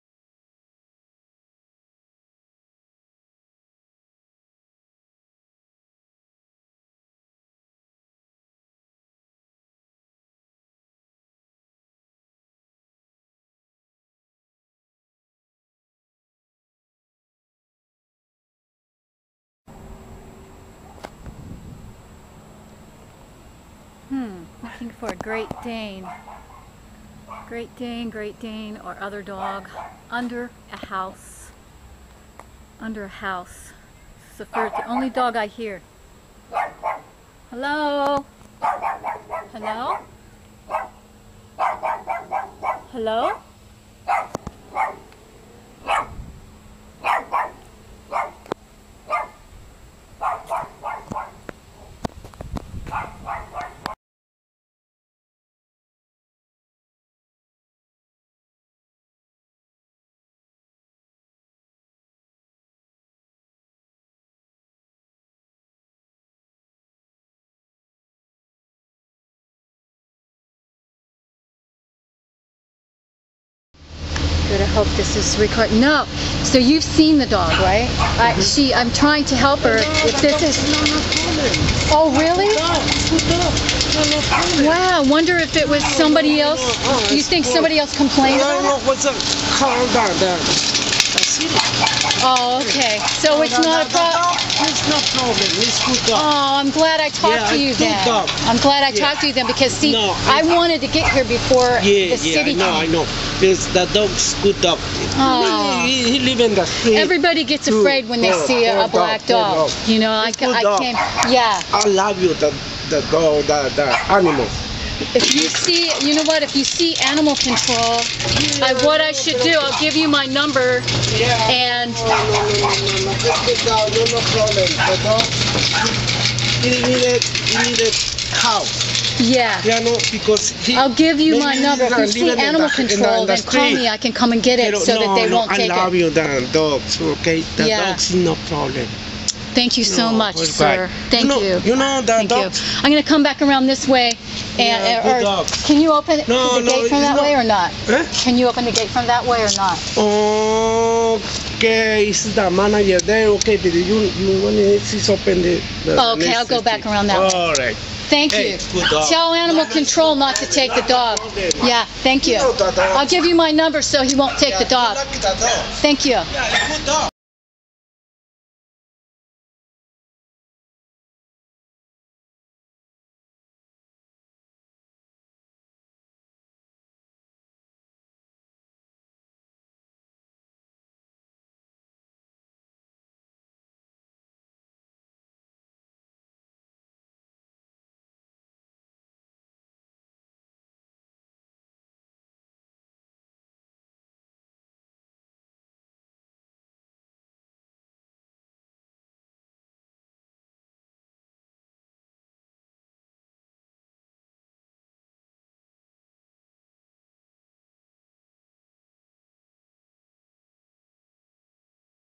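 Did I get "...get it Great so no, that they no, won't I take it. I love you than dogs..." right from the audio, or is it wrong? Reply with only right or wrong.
wrong.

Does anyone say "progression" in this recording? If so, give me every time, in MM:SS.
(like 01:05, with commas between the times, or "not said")
not said.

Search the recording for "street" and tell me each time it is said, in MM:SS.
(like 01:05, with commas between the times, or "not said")
01:46.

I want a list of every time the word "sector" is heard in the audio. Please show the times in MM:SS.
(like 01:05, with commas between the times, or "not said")
not said.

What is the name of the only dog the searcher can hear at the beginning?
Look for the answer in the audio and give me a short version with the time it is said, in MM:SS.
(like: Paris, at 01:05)
Safir, at 00:34.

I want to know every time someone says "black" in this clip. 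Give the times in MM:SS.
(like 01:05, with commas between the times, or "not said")
01:48.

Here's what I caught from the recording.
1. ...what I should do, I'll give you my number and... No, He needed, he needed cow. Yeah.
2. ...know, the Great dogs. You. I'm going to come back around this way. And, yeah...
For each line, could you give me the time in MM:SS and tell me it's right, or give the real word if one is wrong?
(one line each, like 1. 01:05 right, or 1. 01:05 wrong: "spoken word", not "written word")
1. 01:58 right
2. 02:21 wrong: "Thank", not "Great".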